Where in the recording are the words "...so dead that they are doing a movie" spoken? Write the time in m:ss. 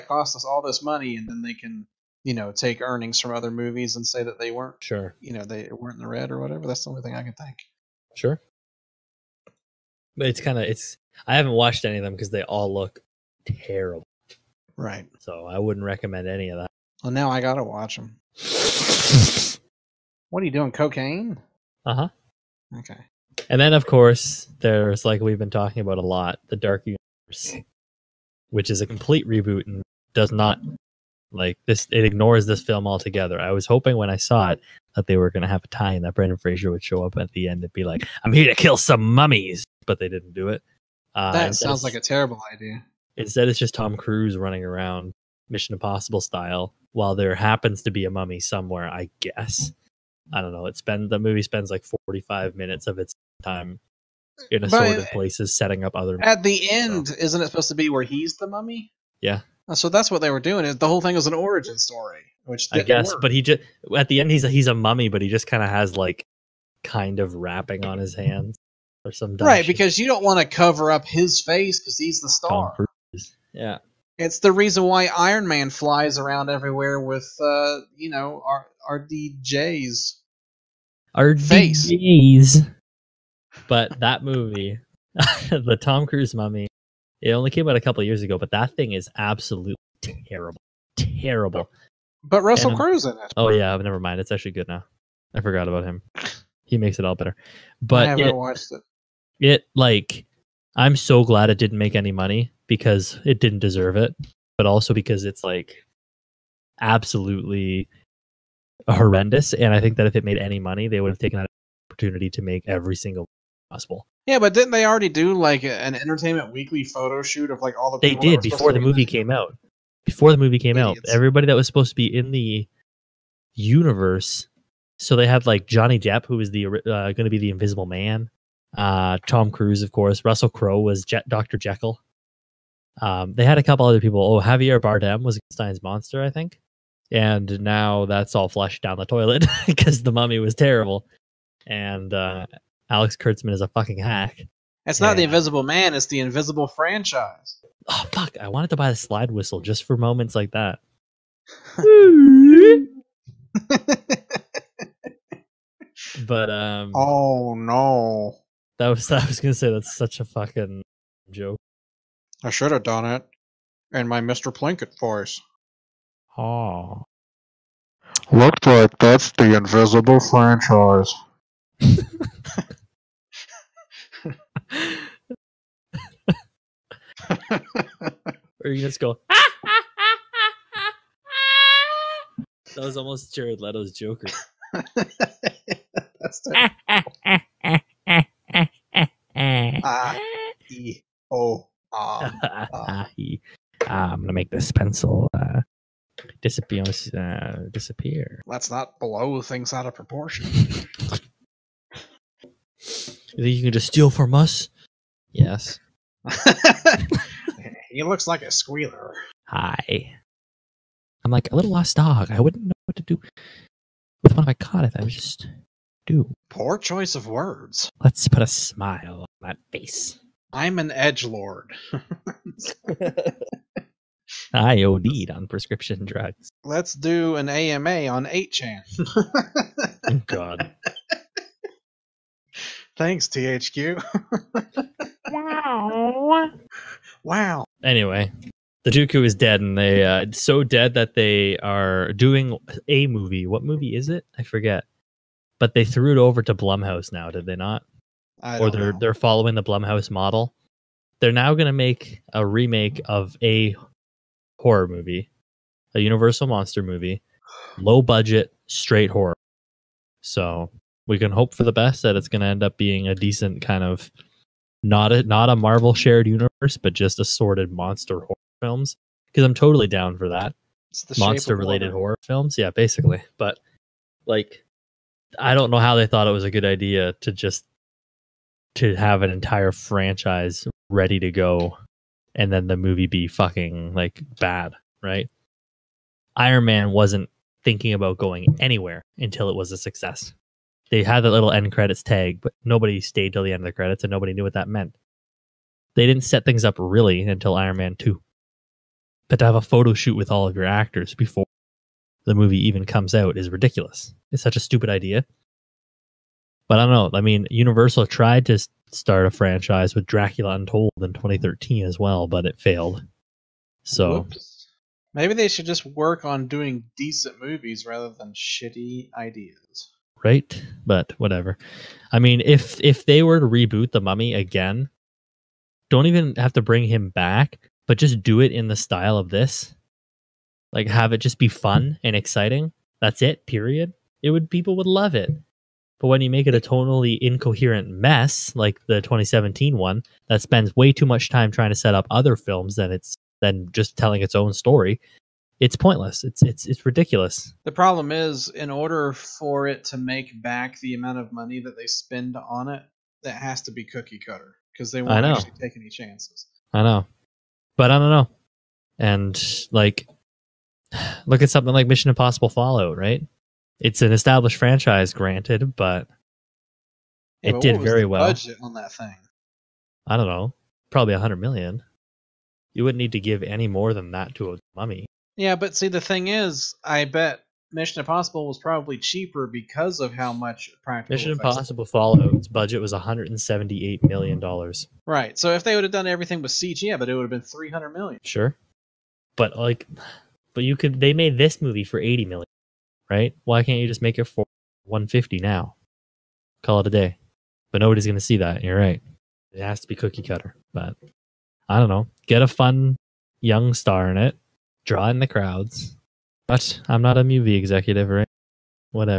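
4:00.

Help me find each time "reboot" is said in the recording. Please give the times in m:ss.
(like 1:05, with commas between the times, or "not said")
0:29, 5:23.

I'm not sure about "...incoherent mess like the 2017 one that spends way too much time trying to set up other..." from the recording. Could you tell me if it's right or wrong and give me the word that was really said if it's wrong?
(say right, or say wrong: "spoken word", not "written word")
right.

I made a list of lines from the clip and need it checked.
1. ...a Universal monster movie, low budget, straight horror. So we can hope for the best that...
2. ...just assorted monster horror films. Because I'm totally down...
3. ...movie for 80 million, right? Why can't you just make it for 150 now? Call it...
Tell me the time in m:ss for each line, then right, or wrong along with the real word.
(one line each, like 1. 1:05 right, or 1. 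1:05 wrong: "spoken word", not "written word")
1. 4:15 right
2. 4:26 right
3. 6:31 right.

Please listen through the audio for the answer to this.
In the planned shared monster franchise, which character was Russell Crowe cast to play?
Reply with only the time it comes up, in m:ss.
2:11.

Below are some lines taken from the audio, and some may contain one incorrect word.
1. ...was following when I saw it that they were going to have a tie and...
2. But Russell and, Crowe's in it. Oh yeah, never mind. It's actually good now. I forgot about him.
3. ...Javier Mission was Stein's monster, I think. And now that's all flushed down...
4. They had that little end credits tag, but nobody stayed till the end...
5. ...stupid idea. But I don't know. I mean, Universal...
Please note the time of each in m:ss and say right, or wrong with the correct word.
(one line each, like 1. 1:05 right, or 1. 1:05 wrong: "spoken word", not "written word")
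1. 0:33 wrong: "hoping", not "following"
2. 1:32 right
3. 2:14 wrong: "Bardem", not "Mission"
4. 4:50 right
5. 5:04 right.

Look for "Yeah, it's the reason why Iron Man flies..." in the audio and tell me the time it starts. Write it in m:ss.
1:13.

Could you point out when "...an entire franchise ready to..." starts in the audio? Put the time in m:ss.
4:39.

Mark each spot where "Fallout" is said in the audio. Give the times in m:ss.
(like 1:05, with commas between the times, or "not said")
6:02, 6:21.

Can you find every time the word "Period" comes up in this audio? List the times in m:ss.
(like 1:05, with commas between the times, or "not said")
5:33.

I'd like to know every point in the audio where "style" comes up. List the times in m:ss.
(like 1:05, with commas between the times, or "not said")
0:46, 5:28.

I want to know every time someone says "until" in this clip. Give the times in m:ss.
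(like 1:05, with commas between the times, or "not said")
4:49, 4:57.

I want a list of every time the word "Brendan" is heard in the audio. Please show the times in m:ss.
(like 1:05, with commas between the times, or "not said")
0:36.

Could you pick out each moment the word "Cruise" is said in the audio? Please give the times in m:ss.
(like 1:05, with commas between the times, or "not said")
0:43, 1:26, 2:09.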